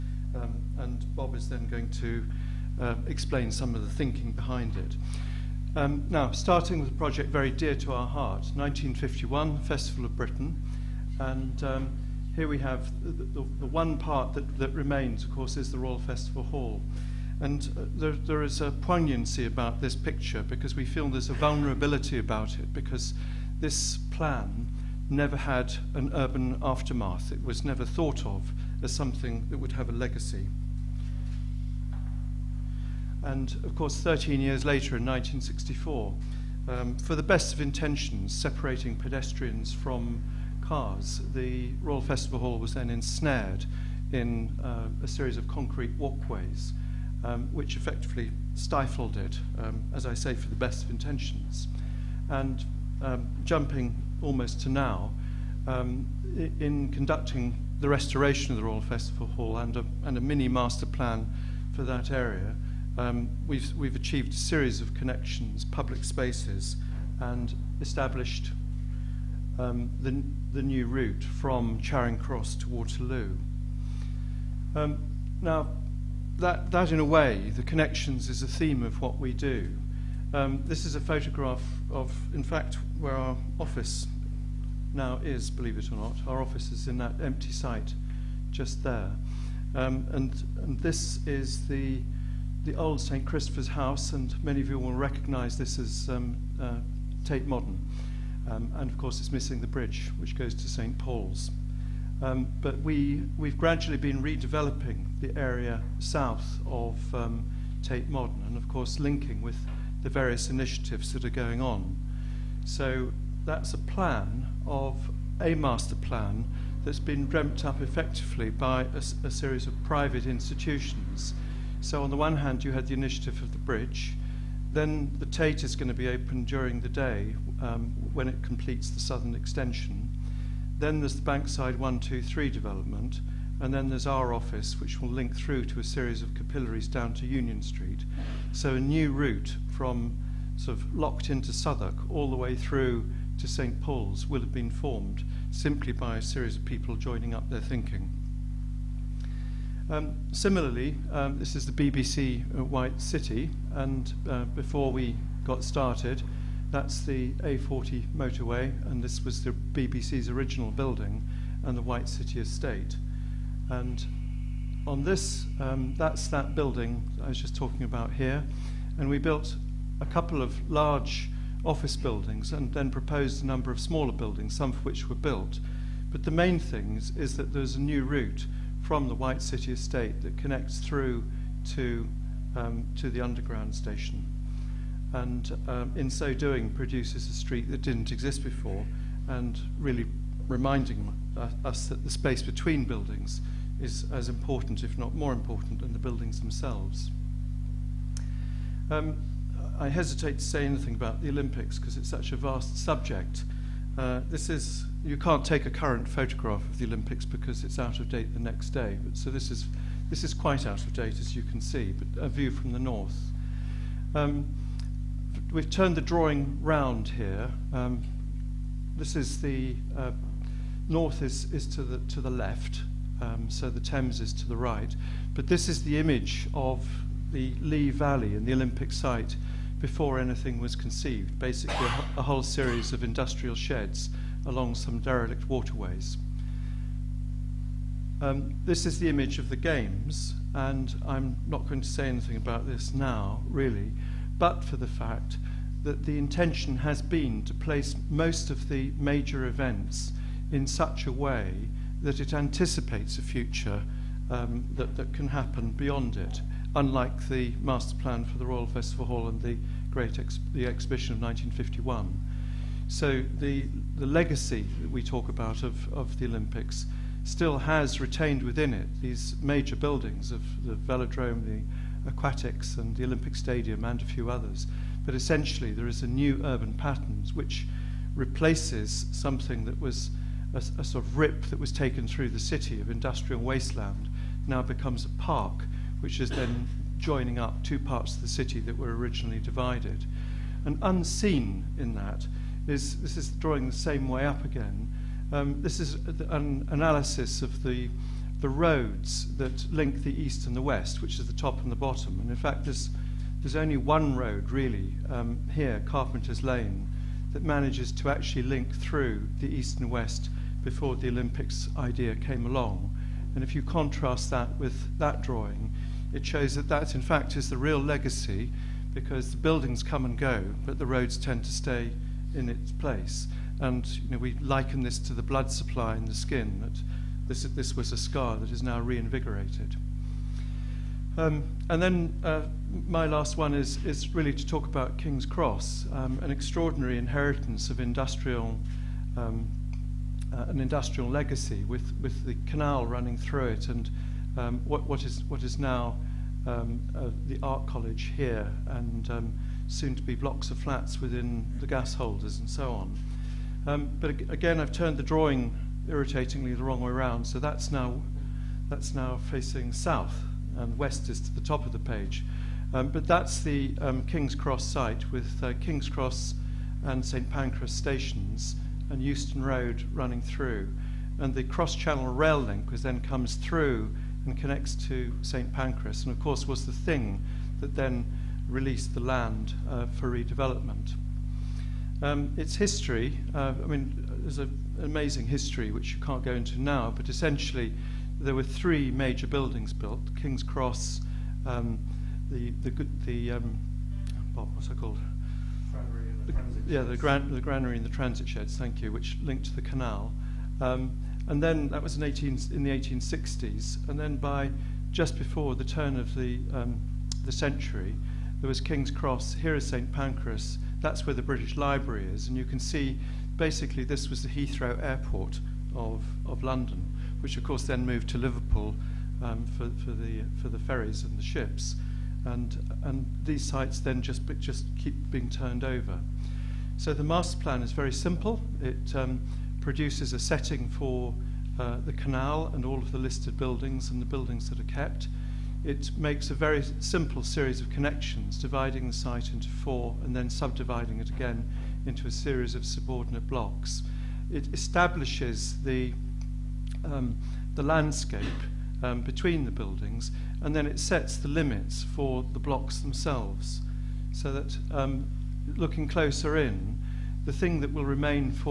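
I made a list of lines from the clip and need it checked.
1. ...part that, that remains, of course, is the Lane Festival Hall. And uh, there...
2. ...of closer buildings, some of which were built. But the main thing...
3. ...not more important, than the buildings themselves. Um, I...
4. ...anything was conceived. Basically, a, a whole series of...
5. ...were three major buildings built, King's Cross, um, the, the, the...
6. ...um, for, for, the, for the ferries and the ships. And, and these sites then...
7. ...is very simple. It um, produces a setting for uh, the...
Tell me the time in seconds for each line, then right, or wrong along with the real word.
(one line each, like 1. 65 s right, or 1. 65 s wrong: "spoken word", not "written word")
1. 13 s wrong: "Royal", not "Lane"
2. 173 s wrong: "smaller", not "closer"
3. 194 s right
4. 230 s right
5. 388 s right
6. 419 s right
7. 427 s right.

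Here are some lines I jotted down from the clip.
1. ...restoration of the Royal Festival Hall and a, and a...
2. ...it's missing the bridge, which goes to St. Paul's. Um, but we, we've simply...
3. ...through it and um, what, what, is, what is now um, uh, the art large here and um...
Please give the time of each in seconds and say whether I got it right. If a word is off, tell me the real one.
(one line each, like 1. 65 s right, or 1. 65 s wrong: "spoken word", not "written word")
1. 57 s right
2. 99 s wrong: "gradually", not "simply"
3. 343 s wrong: "college", not "large".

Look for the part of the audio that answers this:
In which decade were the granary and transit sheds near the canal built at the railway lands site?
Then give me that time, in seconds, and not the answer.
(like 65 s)
402 s.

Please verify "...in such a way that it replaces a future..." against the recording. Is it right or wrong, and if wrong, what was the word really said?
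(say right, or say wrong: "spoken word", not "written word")
wrong: "anticipates", not "replaces".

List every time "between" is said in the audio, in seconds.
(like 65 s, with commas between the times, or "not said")
192 s, 449 s.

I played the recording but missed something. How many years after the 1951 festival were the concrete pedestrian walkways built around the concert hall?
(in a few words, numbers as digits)
13.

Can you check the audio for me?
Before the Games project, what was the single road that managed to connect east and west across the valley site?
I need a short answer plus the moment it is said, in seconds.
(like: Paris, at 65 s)
Carpenter's Lane, at 305 s.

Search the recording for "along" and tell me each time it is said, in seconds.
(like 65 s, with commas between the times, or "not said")
234 s, 312 s.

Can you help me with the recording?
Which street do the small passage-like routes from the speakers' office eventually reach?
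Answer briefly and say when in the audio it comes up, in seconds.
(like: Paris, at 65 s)
Union Street, at 137 s.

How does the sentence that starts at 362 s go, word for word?
Um, but that's the um, King's Cross site with uh, King's Cross and St Pancras stations and Euston Road running through.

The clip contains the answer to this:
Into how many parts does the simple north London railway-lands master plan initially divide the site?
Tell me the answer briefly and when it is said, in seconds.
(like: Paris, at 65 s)
4, at 439 s.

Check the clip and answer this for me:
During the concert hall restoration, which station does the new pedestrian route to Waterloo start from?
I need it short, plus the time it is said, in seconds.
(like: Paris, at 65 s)
Charing Cross, at 71 s.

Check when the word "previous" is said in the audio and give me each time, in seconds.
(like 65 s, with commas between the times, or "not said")
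not said.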